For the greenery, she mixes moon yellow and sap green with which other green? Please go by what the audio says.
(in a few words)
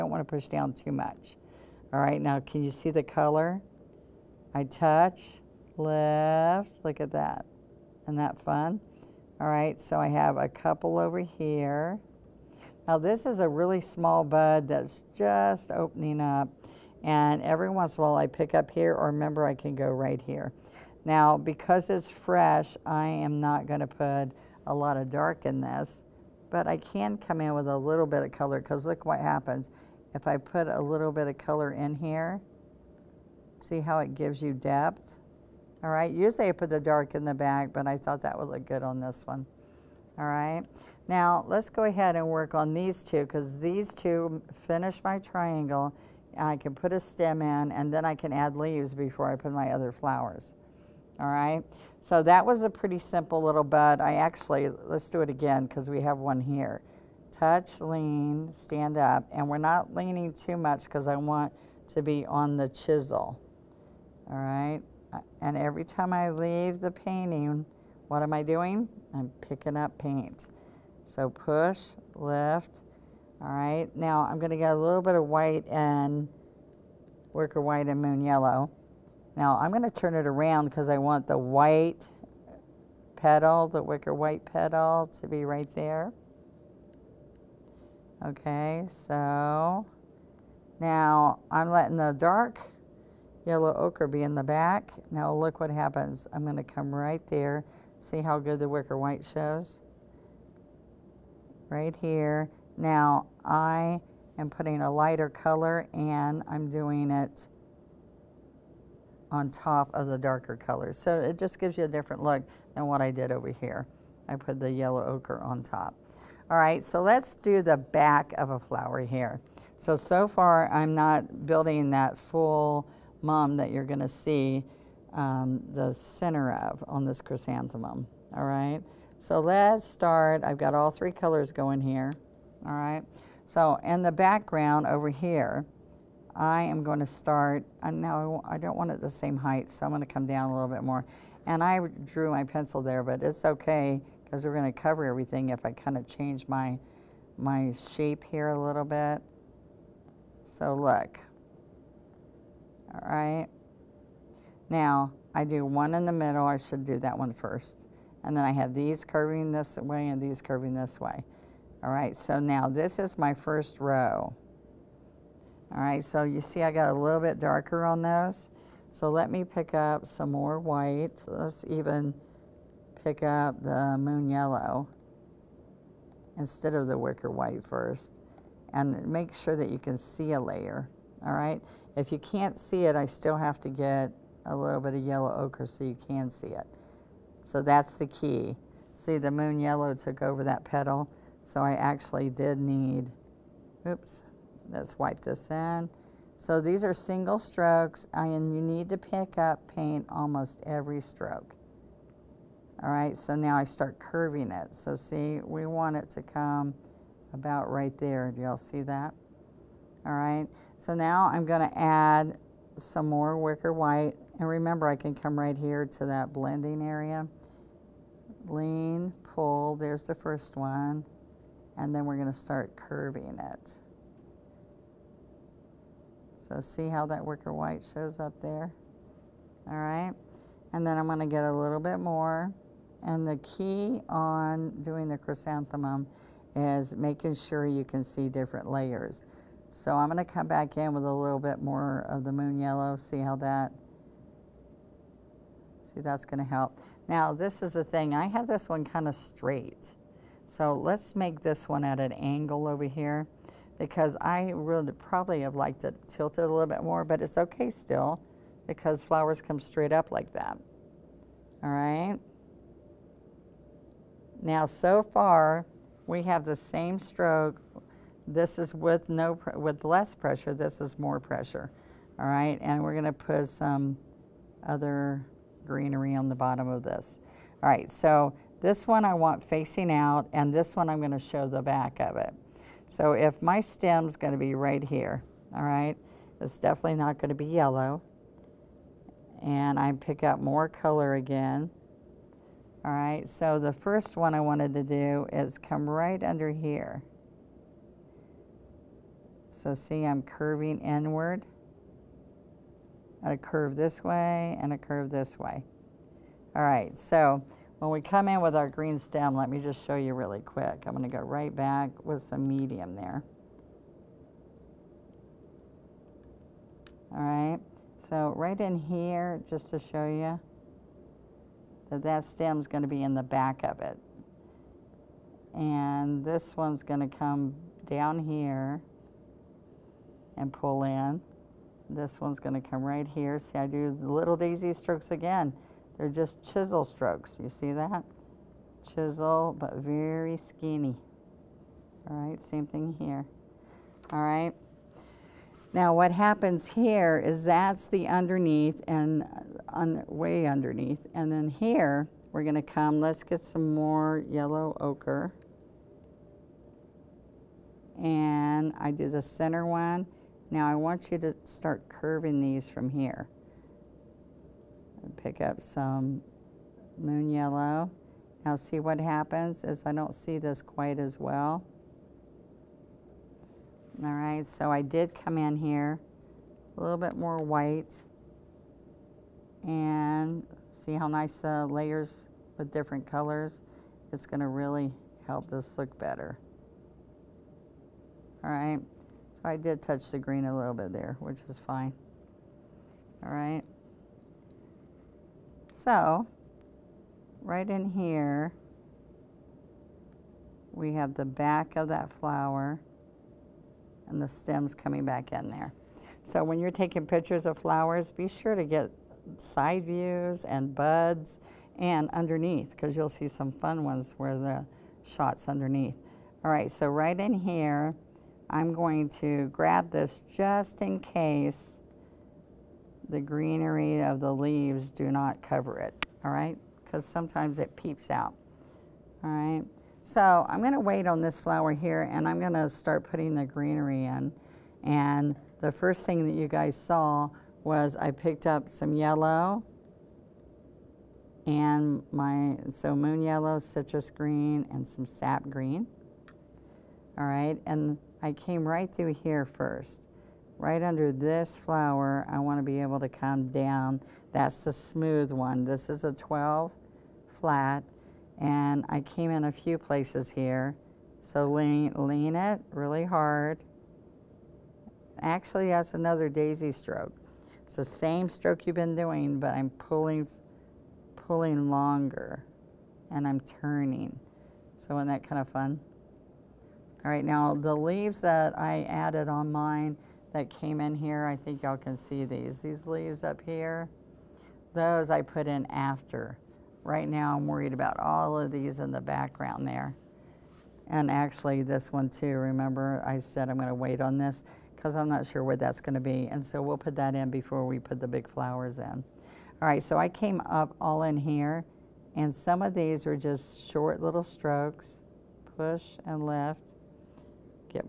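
citrus green.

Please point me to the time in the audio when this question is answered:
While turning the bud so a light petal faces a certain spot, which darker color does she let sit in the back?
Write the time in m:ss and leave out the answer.
1:32.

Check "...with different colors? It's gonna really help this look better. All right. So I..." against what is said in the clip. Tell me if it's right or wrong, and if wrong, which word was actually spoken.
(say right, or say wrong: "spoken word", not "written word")
right.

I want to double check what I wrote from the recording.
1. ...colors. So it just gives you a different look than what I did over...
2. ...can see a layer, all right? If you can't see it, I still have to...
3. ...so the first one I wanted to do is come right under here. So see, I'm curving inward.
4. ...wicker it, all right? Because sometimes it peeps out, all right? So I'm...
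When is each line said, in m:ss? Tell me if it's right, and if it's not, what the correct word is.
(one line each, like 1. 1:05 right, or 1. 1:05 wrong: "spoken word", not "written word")
1. 1:50 right
2. 2:59 right
3. 4:53 right
4. 7:05 wrong: "cover", not "wicker".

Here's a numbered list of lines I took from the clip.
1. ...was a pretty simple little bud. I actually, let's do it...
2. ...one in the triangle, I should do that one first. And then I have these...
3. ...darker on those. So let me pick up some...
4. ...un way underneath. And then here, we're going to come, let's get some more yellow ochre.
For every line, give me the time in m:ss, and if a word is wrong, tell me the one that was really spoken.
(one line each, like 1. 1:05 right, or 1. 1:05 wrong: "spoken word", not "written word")
1. 0:52 right
2. 2:35 wrong: "middle", not "triangle"
3. 2:47 right
4. 5:49 right.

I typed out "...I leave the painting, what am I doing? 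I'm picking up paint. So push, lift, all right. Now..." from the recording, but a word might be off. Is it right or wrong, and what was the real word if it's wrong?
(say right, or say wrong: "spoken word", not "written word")
right.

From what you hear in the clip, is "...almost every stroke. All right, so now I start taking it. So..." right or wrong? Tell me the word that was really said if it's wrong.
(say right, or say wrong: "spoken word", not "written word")
wrong: "curving", not "taking".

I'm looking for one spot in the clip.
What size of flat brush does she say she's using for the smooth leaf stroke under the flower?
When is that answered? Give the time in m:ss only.
7:36.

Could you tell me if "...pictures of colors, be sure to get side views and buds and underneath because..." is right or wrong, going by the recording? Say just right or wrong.
wrong.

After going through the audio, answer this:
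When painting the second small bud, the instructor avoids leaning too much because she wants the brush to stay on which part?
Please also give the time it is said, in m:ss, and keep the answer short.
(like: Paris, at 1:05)
the chisel, at 1:02.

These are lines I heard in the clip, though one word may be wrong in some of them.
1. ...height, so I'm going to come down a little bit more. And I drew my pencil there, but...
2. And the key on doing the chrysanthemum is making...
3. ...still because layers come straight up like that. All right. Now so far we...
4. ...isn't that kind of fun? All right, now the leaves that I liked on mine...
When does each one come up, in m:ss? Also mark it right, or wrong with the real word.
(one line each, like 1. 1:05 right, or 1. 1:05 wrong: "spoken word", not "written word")
1. 2:19 right
2. 3:53 right
3. 4:17 wrong: "flowers", not "layers"
4. 7:54 wrong: "added", not "liked".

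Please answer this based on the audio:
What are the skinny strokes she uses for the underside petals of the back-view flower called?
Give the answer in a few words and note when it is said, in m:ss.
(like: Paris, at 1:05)
daisy strokes, at 5:34.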